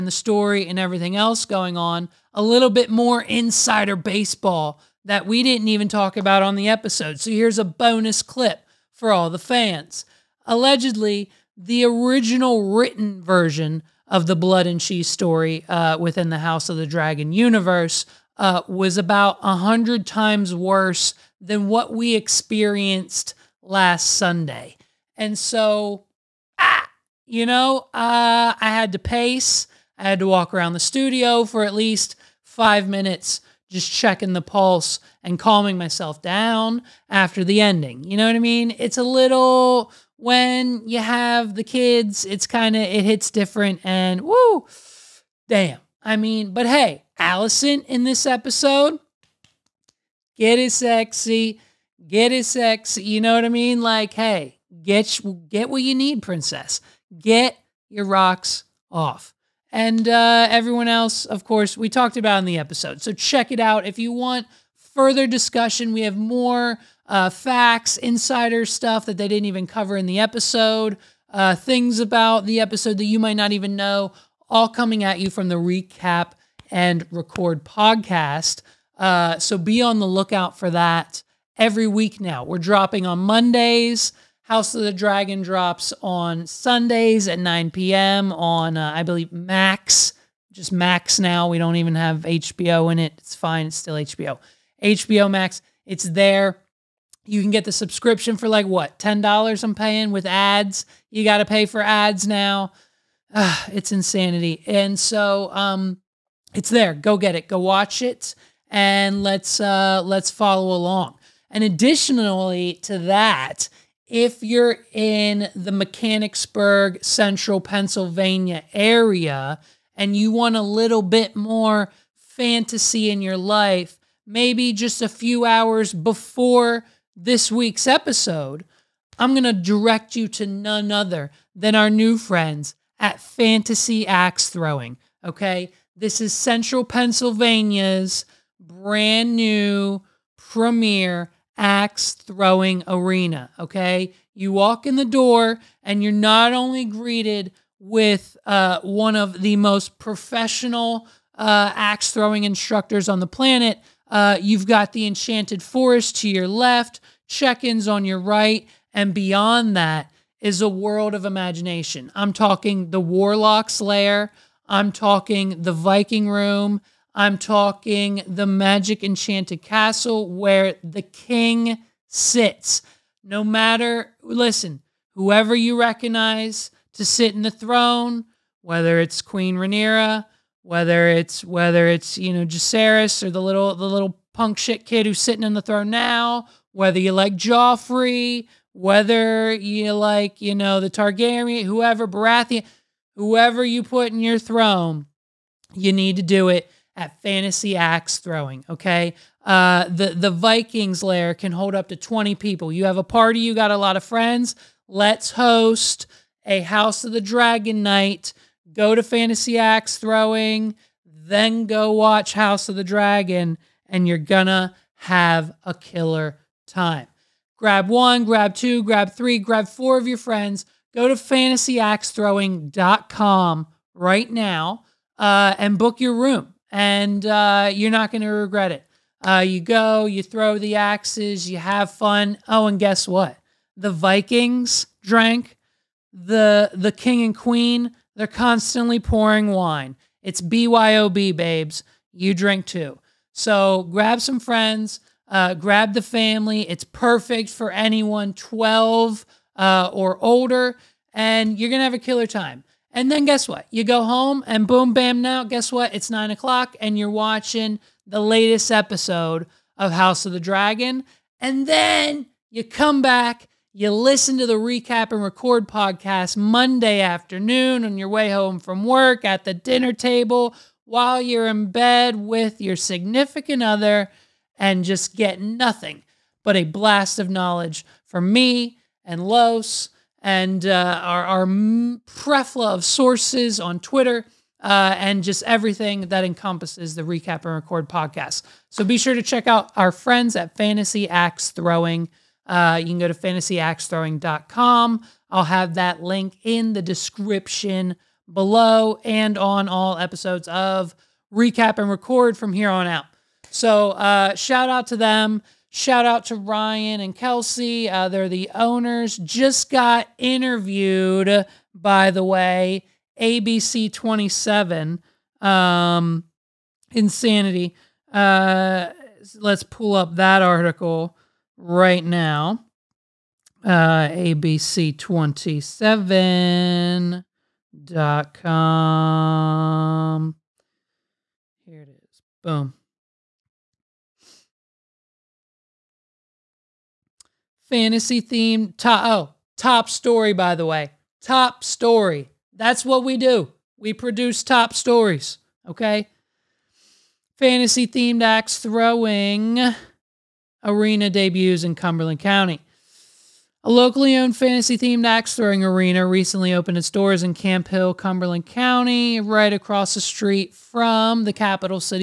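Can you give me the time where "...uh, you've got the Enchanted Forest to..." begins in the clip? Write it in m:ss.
2:34.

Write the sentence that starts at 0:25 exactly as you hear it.
And so, ah, you know, uh, I had to pace.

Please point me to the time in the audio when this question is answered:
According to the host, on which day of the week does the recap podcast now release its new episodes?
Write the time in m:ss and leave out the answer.
1:23.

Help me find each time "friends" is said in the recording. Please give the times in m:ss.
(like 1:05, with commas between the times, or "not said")
2:12, 3:24, 3:40, 4:04, 4:49.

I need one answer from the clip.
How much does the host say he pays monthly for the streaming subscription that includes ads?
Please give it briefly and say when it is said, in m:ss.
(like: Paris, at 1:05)
$10, at 1:38.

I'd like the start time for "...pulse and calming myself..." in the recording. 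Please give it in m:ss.
0:34.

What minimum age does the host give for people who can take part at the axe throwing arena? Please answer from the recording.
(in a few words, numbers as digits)
12.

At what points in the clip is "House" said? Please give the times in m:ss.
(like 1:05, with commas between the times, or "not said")
0:16, 1:24, 3:26, 3:32, 4:19.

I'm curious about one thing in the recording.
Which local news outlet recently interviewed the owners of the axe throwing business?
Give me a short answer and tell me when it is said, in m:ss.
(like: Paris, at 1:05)
ABC 27, at 5:13.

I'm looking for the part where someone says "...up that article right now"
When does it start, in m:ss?
5:19.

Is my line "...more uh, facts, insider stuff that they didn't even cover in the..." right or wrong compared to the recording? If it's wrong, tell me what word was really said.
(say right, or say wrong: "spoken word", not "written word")
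right.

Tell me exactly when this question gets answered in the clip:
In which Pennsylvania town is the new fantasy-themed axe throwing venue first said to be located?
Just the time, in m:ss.
1:55.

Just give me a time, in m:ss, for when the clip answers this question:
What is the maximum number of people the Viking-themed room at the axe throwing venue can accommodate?
3:21.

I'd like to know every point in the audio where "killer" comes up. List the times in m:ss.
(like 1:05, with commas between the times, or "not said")
3:35, 4:11.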